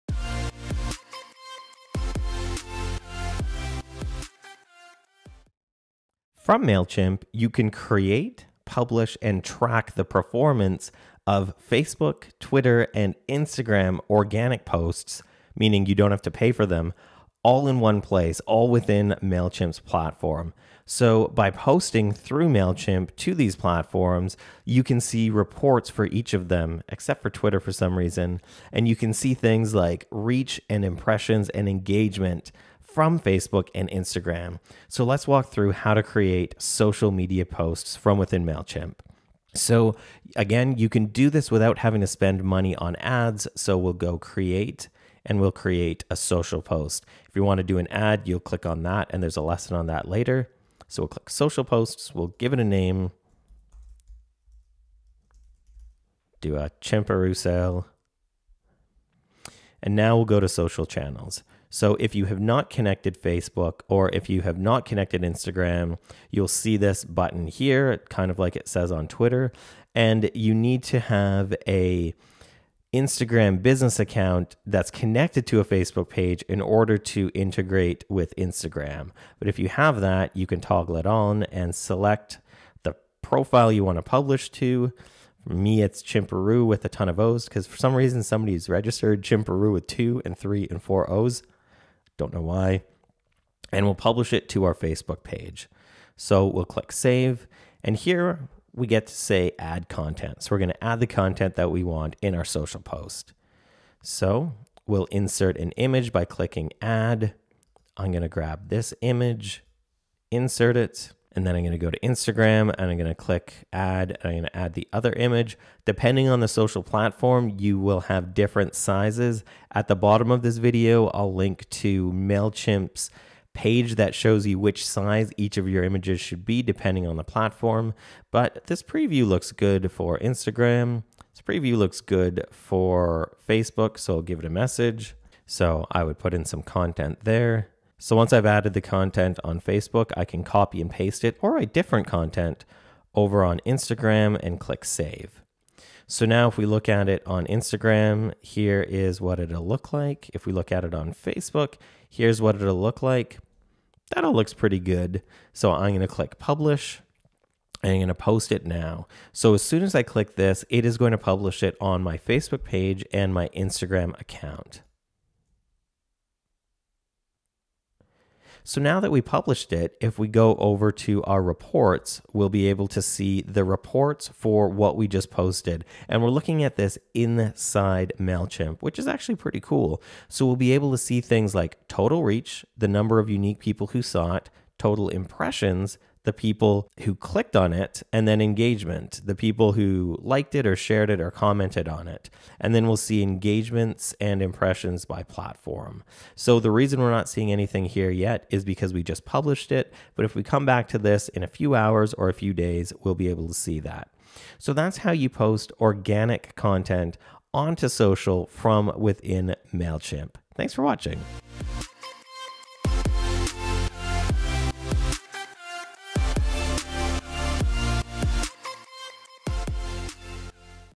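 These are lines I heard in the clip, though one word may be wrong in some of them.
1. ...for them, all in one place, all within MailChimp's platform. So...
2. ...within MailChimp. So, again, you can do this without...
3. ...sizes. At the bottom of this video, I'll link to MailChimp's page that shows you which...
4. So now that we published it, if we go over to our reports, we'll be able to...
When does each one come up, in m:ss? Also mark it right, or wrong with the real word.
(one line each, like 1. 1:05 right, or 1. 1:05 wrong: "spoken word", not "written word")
1. 0:16 right
2. 0:38 right
3. 1:58 right
4. 2:48 right.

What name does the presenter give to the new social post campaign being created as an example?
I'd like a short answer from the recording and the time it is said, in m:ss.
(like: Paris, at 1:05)
chimparoo sale, at 0:56.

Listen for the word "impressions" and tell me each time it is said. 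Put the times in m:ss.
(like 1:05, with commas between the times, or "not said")
0:30, 3:05, 3:14.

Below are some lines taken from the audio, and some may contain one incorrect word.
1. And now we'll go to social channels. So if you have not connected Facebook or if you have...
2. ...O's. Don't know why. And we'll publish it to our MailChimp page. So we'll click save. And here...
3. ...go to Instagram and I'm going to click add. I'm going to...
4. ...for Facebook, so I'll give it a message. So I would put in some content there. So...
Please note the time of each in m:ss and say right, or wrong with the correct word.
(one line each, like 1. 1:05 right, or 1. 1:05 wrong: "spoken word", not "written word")
1. 0:59 right
2. 1:31 wrong: "Facebook", not "MailChimp"
3. 1:51 right
4. 2:12 right.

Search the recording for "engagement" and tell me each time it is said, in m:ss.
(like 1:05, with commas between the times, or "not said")
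0:31, 3:08, 3:13.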